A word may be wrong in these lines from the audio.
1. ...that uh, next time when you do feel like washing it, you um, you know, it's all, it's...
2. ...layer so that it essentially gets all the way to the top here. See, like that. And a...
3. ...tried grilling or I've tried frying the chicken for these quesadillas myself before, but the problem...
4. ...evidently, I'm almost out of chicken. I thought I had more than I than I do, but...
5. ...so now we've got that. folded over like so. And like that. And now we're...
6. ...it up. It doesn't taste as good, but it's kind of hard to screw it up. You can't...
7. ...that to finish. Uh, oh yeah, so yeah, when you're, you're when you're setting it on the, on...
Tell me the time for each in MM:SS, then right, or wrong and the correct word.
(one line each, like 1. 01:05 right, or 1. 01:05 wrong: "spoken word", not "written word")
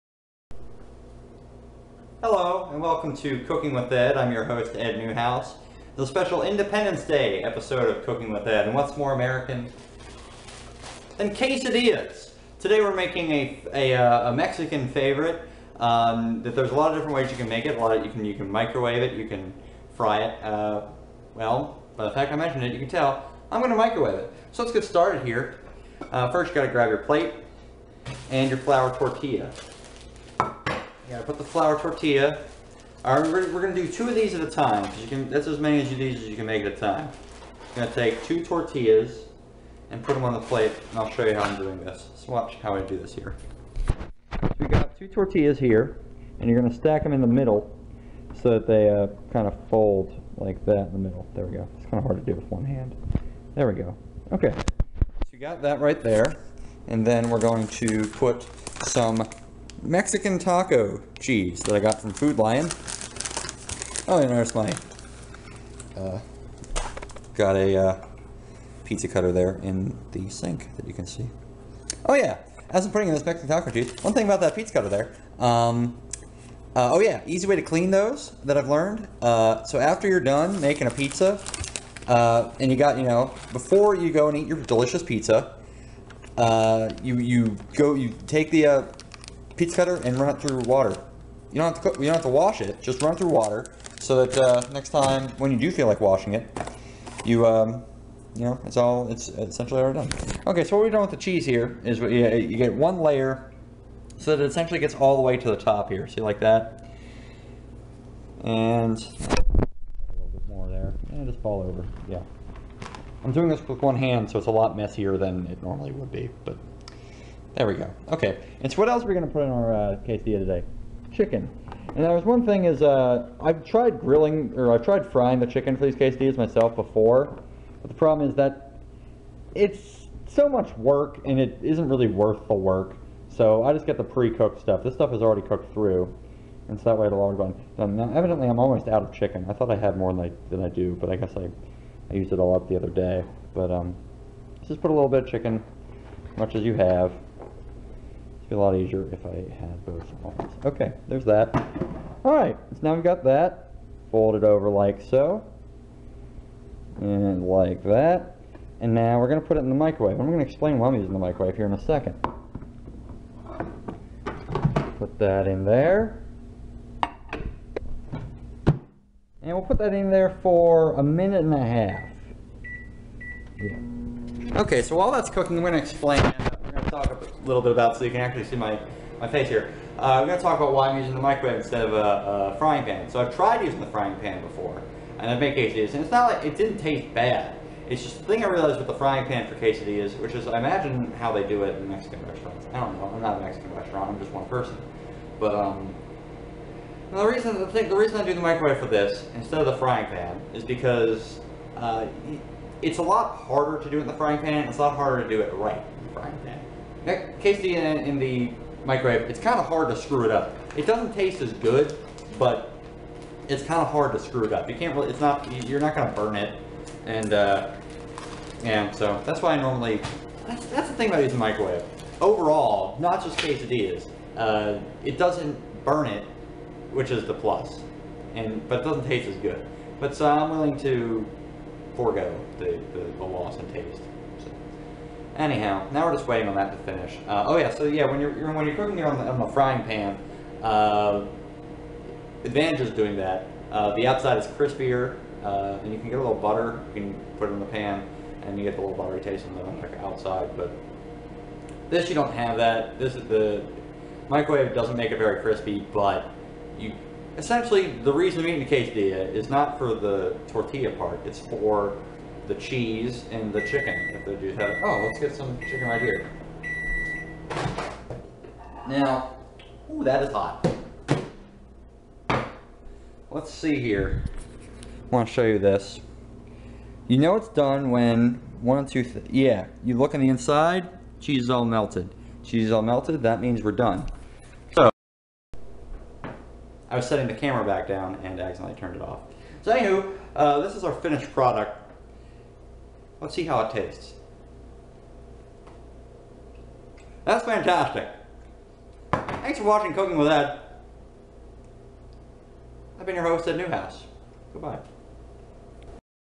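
1. 01:34 right
2. 01:43 right
3. 02:03 right
4. 02:18 right
5. 02:32 right
6. 03:30 right
7. 03:56 wrong: "cooking", not "setting".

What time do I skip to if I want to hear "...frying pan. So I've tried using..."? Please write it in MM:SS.
03:02.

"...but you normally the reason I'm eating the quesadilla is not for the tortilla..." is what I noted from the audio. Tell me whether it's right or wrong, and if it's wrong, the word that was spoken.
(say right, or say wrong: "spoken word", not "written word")
wrong: "essentially", not "normally".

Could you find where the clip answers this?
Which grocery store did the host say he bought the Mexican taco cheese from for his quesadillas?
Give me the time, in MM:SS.
01:02.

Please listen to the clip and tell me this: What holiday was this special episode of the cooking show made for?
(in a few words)
Independence Day.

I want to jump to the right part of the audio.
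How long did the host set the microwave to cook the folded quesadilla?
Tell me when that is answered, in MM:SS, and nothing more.
02:50.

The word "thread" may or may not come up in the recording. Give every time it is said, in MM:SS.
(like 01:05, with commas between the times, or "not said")
not said.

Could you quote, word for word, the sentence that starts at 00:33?
All right, we're, we're gonna do two of these at a time.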